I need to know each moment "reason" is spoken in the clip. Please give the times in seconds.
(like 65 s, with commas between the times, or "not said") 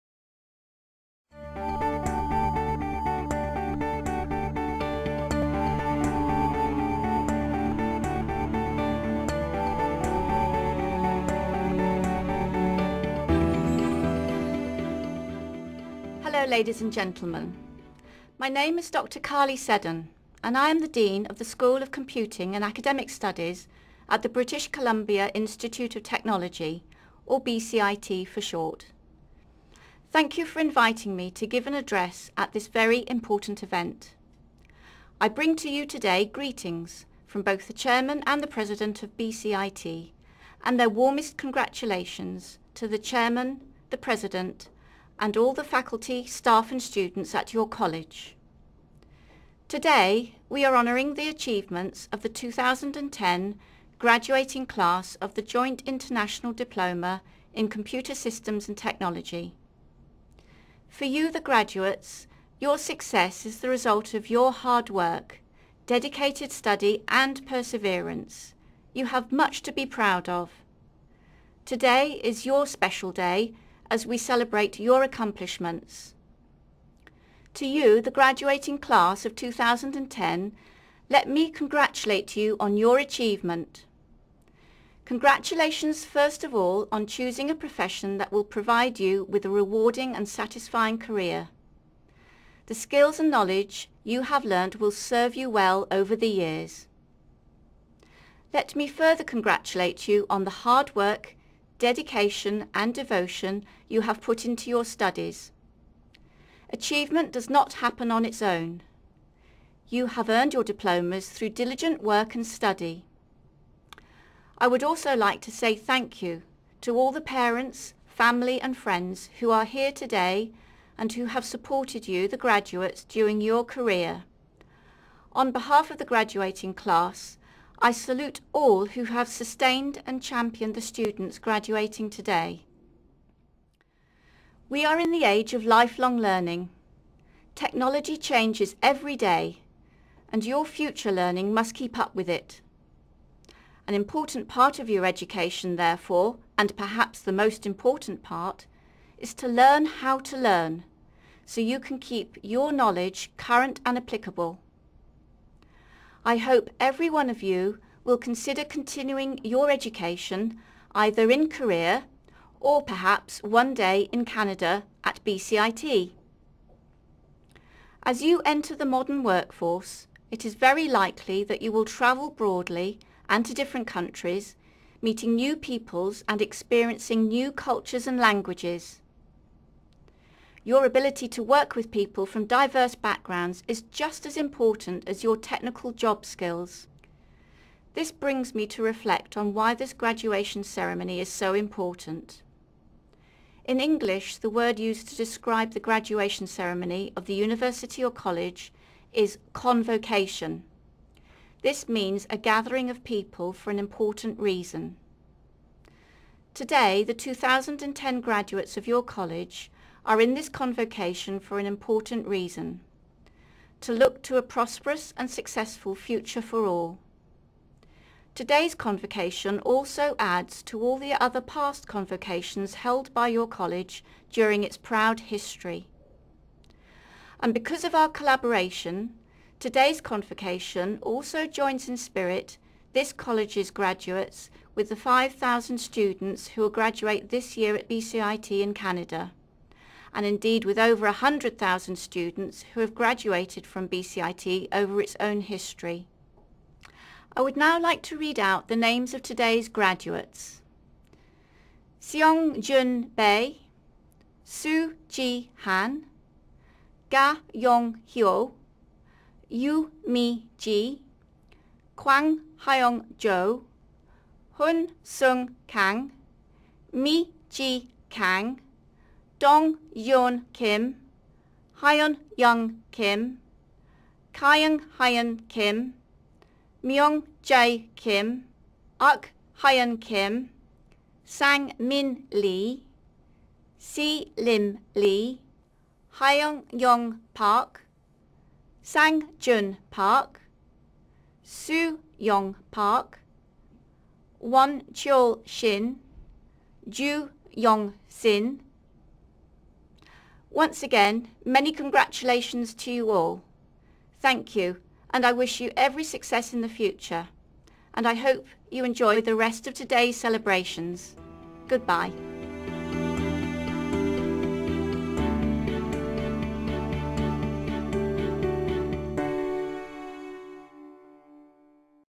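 204 s, 212 s.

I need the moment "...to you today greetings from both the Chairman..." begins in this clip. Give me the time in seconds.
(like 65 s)
35 s.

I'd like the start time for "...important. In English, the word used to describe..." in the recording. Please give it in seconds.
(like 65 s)
191 s.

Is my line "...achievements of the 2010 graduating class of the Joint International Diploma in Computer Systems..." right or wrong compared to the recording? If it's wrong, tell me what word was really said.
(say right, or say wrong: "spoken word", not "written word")
right.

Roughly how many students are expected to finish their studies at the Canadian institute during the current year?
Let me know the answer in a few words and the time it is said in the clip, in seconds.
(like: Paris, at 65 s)
5,000, at 234 s.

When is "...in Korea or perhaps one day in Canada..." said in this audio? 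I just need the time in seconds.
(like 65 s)
161 s.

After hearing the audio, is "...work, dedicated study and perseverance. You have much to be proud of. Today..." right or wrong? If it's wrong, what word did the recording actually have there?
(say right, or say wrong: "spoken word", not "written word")
right.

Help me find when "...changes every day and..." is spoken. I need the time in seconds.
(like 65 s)
138 s.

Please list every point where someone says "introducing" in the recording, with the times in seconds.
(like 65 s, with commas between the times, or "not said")
not said.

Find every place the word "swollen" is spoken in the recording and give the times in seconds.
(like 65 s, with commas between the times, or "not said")
not said.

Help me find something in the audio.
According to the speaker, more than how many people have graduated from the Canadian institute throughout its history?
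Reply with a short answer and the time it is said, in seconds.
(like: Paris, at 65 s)
100,000, at 241 s.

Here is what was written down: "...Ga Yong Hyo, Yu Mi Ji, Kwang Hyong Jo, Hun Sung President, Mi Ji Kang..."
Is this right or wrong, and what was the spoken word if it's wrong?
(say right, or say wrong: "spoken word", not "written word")
wrong: "Kang", not "President".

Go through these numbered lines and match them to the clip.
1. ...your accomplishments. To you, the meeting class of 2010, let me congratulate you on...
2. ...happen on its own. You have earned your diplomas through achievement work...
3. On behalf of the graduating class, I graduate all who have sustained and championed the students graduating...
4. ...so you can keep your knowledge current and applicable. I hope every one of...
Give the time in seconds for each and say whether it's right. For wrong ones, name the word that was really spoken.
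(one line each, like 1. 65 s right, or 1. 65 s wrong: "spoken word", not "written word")
1. 74 s wrong: "graduating", not "meeting"
2. 107 s wrong: "diligent", not "achievement"
3. 125 s wrong: "salute", not "graduate"
4. 151 s right.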